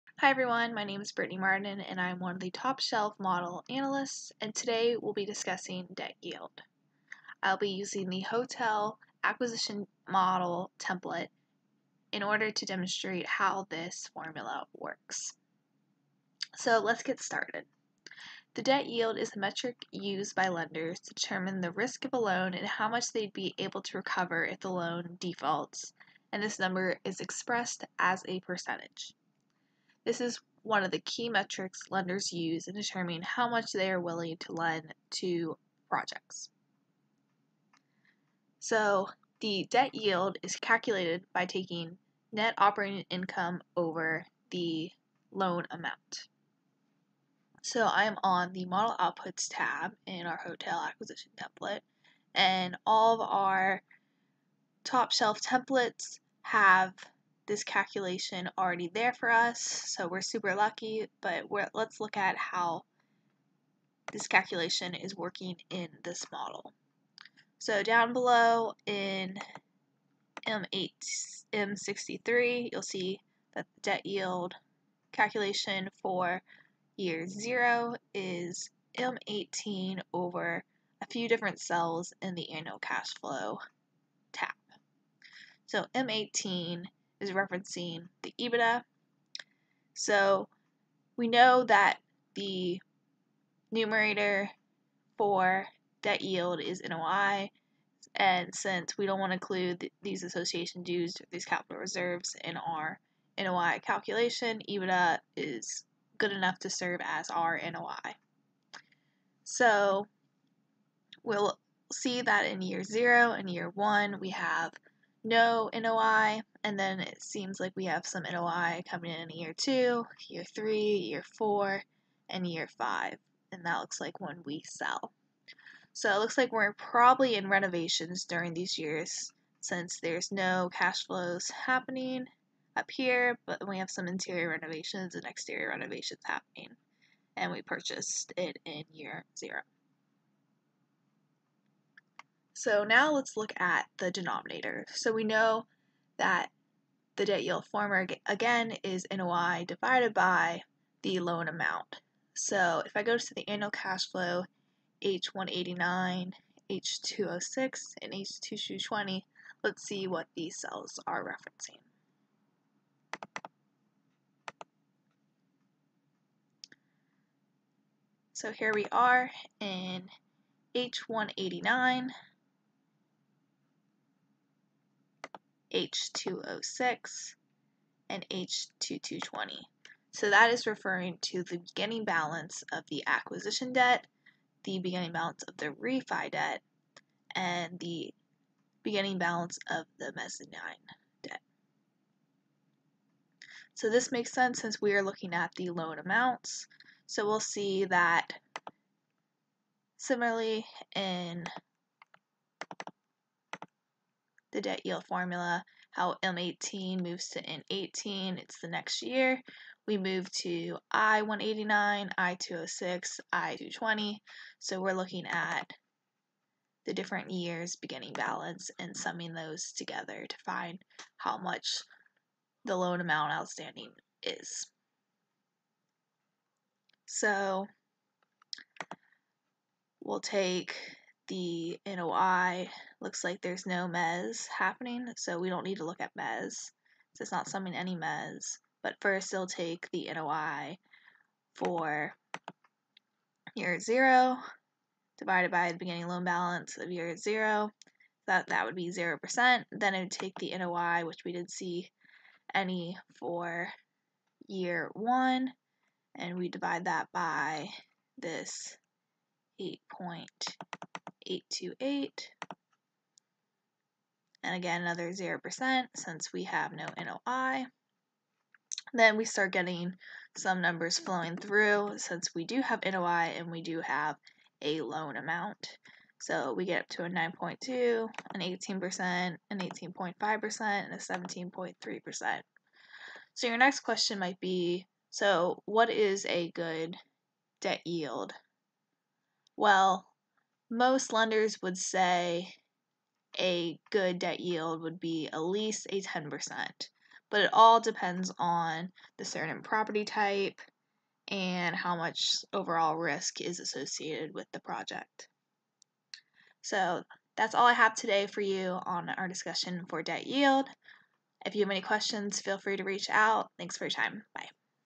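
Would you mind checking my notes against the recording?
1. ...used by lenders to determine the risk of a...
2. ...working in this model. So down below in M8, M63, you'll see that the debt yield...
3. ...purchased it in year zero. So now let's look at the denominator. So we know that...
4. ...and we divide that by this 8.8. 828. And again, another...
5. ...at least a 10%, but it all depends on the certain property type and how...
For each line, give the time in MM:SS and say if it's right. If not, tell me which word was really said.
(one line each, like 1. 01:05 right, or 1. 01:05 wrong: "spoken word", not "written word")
1. 00:19 right
2. 01:05 right
3. 02:17 right
4. 04:16 right
5. 04:55 right.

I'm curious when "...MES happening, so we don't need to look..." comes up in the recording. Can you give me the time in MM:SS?
03:53.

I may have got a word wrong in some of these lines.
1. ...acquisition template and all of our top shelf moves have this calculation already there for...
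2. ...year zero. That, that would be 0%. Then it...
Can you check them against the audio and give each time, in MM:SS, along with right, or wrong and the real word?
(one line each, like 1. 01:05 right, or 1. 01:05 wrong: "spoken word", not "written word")
1. 00:50 wrong: "templates", not "moves"
2. 04:06 right.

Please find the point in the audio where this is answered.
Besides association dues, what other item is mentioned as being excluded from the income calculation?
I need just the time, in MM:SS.
01:41.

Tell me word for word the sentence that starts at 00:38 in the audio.
So the debt yield is calculated by taking net operating income over the loan amount.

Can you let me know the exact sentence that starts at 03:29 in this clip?
We move to I189, I206, I220.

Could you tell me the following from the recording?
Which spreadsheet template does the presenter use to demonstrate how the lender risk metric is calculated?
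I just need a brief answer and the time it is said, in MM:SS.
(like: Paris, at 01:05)
Hotel acquisition model, at 00:08.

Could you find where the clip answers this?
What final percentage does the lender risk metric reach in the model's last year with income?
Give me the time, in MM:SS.
04:40.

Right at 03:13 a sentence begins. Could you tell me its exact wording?
So this makes sense since we are looking at the loan amounts.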